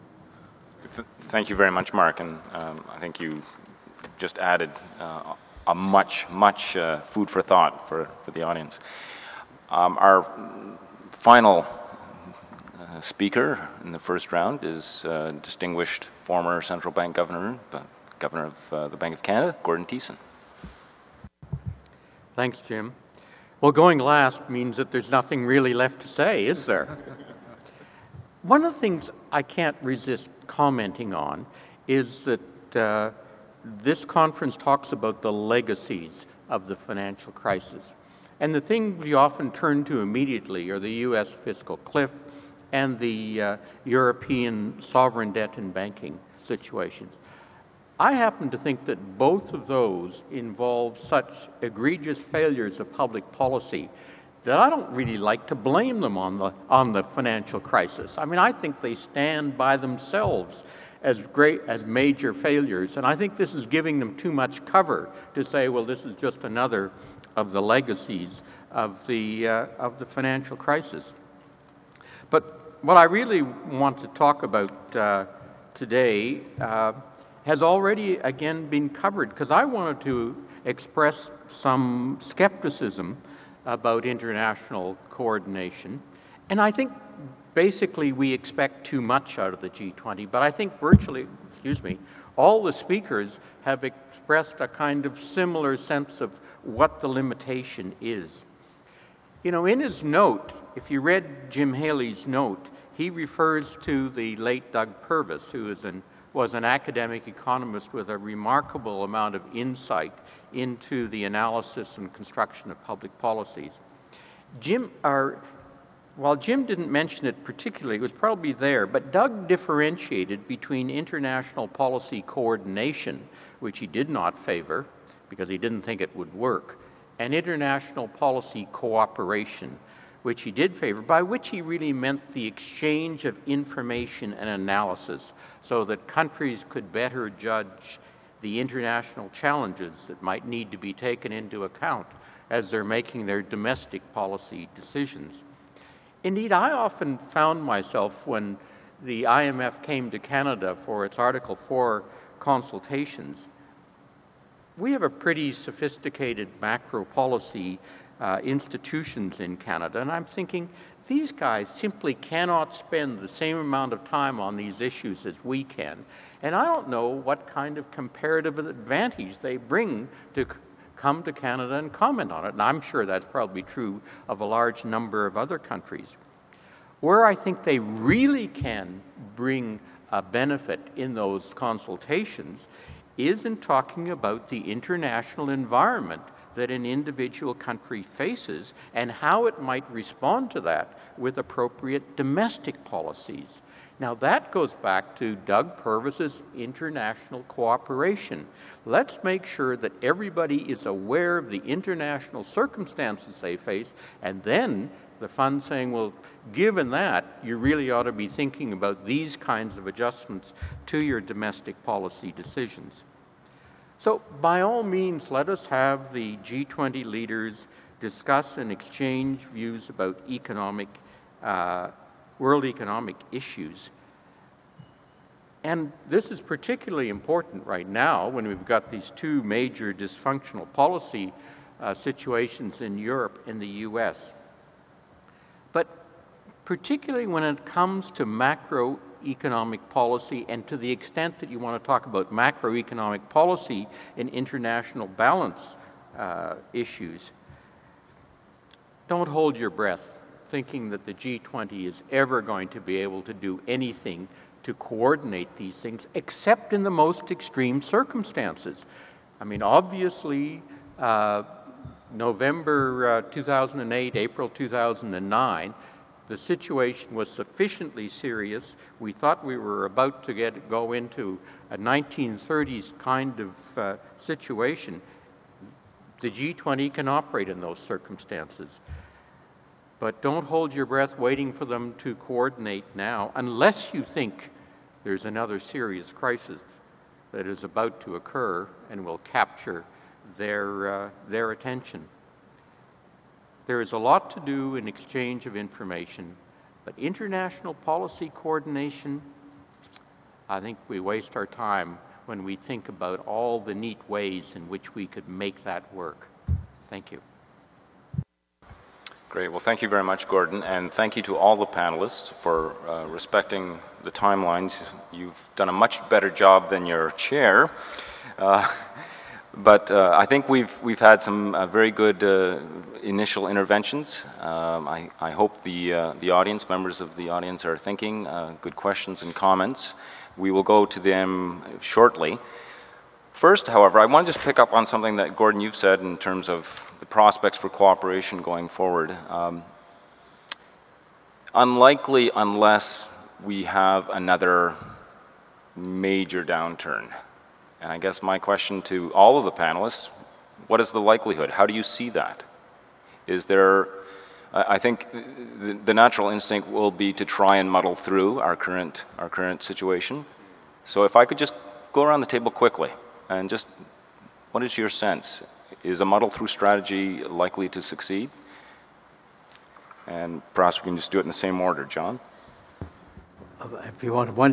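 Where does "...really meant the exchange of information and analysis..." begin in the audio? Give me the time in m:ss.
2:11.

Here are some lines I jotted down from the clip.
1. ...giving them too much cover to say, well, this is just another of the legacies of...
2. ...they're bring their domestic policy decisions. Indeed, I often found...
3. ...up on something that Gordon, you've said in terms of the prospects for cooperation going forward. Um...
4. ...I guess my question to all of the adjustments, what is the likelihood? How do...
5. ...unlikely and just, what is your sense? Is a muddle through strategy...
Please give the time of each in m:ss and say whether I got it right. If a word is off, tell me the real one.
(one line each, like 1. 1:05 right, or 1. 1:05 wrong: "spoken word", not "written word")
1. 1:03 right
2. 2:22 wrong: "making", not "bring"
3. 5:34 right
4. 5:47 wrong: "panelists", not "adjustments"
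5. 6:02 wrong: "quickly", not "unlikely".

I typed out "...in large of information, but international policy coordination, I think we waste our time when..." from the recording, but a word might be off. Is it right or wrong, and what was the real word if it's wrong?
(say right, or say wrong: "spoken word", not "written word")
wrong: "exchange", not "large".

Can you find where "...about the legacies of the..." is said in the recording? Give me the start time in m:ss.
0:34.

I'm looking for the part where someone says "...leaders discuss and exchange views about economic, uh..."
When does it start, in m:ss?
3:37.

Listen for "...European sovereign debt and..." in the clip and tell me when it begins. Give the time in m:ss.
0:43.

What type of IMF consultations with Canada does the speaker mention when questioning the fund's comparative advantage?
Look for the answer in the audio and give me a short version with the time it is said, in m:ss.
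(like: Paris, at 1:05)
Article 4 consultations, at 2:31.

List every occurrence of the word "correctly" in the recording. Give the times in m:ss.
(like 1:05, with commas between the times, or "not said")
not said.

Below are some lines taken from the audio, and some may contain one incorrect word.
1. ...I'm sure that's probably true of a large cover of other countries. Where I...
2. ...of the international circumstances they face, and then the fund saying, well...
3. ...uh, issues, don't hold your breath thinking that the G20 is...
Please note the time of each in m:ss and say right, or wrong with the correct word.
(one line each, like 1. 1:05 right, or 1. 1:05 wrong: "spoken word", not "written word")
1. 2:52 wrong: "number", not "cover"
2. 3:21 right
3. 4:06 right.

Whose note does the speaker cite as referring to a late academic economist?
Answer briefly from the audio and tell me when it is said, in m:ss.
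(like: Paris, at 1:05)
Jim Haley, at 1:41.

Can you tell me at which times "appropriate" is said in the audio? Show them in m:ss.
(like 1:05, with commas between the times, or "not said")
3:11.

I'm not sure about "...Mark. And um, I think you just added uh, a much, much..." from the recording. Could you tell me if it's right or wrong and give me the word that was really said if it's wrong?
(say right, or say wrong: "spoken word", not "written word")
right.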